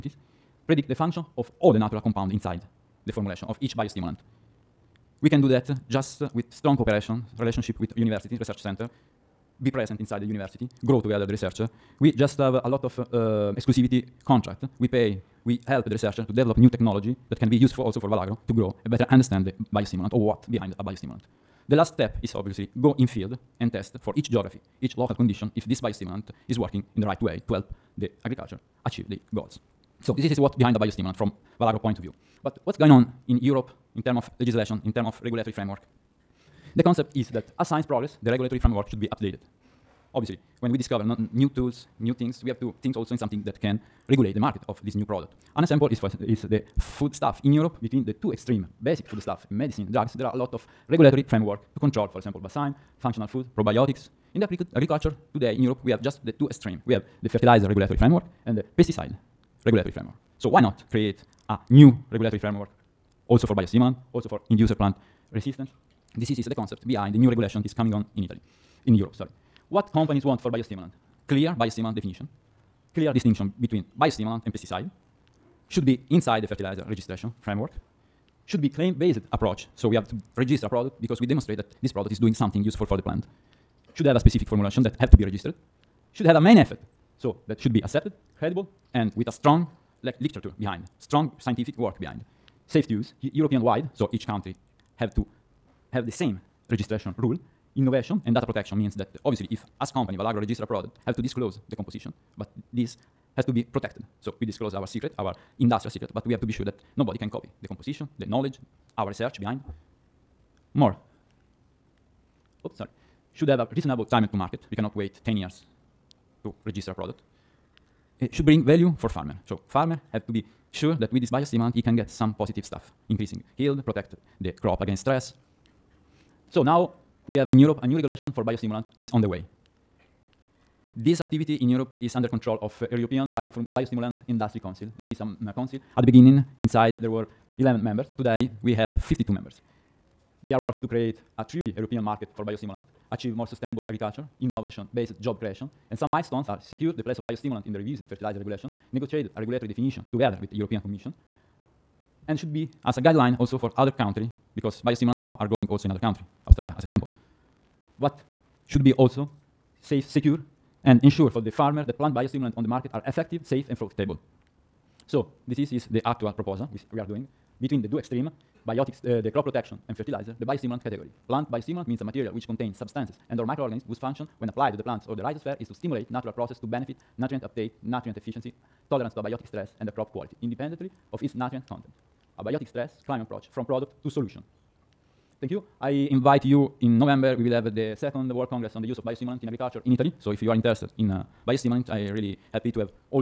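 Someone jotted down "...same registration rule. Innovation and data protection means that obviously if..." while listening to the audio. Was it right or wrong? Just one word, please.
right.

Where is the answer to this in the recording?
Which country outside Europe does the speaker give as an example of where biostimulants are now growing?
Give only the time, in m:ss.
2:36.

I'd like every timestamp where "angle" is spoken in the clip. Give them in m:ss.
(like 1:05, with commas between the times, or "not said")
not said.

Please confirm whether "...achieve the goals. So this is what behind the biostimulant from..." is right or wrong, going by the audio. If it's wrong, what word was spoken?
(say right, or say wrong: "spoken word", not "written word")
right.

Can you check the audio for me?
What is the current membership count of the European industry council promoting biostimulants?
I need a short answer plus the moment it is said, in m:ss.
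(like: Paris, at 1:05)
52, at 2:18.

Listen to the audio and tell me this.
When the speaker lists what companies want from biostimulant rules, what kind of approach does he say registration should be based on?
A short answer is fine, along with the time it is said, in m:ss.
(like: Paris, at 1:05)
Claim-based approach, at 1:18.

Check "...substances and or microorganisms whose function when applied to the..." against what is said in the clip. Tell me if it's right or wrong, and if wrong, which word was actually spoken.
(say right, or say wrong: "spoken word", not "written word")
right.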